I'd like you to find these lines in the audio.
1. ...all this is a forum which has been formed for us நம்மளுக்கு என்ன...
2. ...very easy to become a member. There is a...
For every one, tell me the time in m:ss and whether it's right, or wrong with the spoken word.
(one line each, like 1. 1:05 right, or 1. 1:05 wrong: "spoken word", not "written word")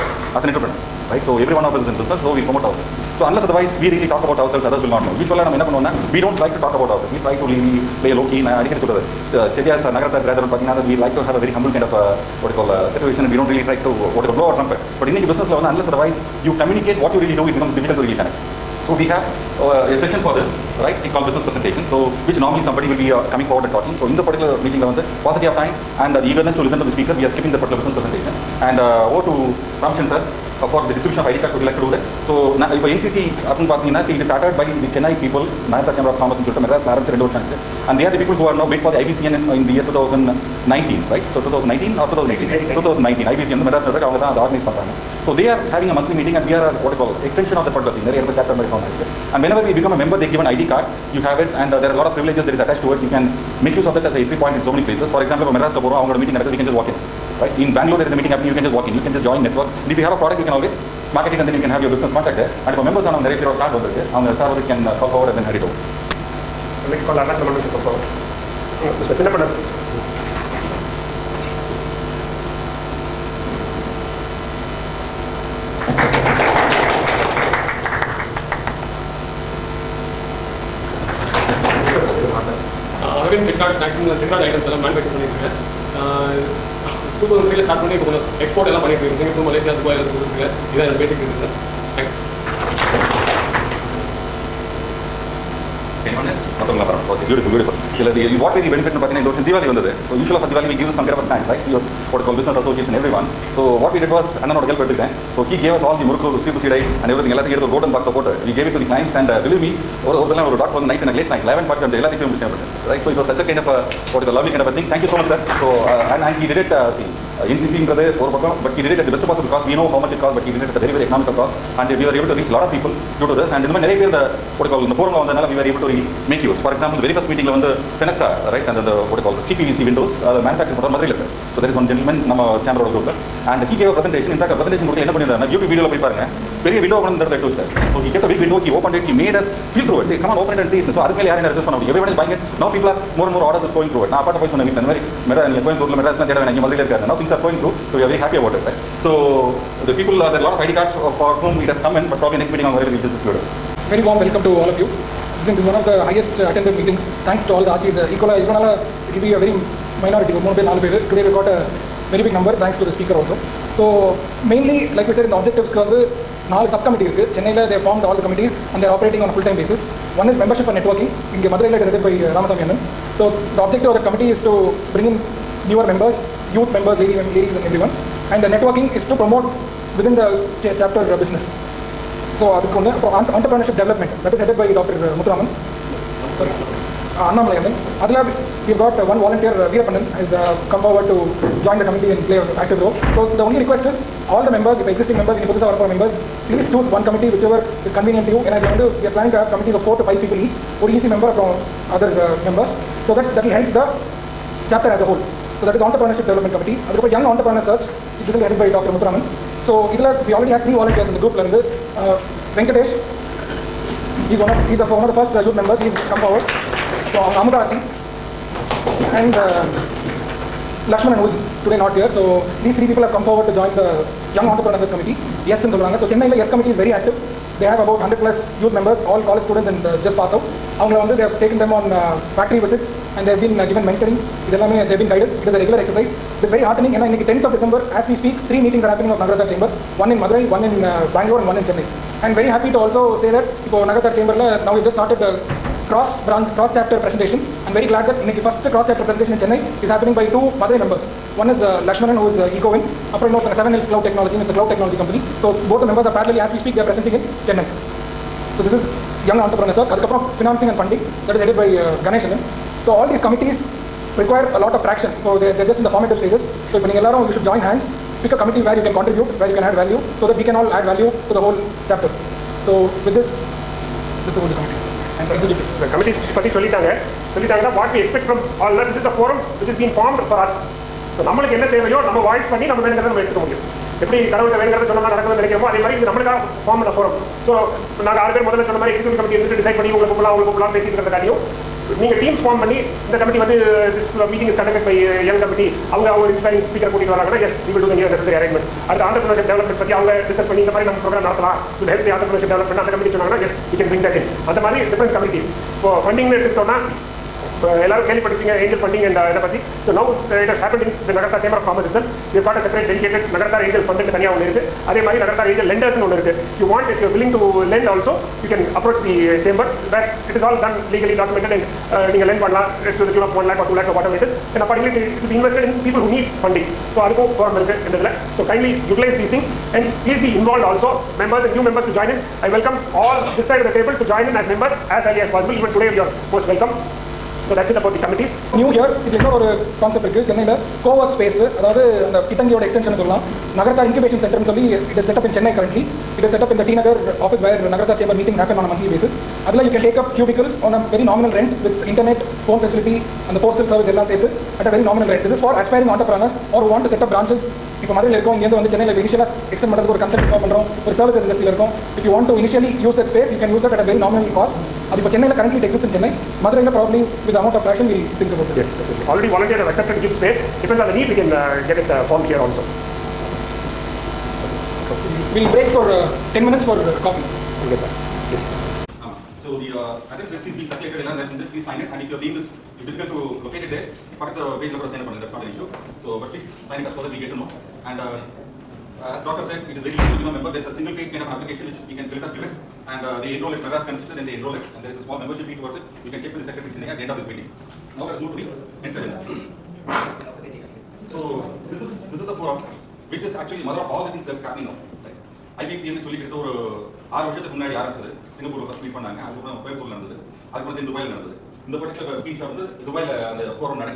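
1. 4:38 right
2. 6:29 right.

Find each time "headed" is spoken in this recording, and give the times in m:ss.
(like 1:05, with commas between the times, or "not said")
3:04, 3:28.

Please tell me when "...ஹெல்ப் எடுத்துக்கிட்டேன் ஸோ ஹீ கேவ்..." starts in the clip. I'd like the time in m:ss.
1:44.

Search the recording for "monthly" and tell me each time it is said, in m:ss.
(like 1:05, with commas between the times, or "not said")
0:45, 5:48.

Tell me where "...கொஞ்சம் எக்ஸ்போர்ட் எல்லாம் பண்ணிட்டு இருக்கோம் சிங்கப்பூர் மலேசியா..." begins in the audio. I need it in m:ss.
1:28.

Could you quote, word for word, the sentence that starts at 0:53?
You can make use of that as a entry point in so many places.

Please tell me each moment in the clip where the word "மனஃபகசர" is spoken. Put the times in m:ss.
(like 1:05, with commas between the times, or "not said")
1:24, 2:10.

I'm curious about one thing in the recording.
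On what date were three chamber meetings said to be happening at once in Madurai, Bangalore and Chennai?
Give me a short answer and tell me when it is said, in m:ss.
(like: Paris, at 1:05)
10th of December, at 3:57.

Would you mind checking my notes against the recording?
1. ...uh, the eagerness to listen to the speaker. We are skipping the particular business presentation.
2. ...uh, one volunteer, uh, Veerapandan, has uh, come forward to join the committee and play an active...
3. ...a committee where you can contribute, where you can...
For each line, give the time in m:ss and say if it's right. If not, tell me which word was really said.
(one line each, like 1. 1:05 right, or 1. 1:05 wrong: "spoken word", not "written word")
1. 0:26 right
2. 3:08 right
3. 4:28 right.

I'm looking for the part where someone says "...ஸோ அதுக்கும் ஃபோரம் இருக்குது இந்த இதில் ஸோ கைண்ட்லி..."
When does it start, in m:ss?
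5:26.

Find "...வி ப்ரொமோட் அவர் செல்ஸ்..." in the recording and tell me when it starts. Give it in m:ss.
0:02.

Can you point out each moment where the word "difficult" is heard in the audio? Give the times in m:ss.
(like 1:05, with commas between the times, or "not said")
0:17, 6:22.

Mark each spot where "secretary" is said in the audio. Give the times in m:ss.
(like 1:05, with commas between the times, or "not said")
6:36.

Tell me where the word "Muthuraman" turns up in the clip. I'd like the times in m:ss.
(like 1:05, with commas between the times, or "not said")
3:28.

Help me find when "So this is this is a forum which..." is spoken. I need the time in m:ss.
6:41.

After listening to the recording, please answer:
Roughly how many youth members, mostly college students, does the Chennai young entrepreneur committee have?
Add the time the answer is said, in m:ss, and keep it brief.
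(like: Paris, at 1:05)
100 plus, at 3:48.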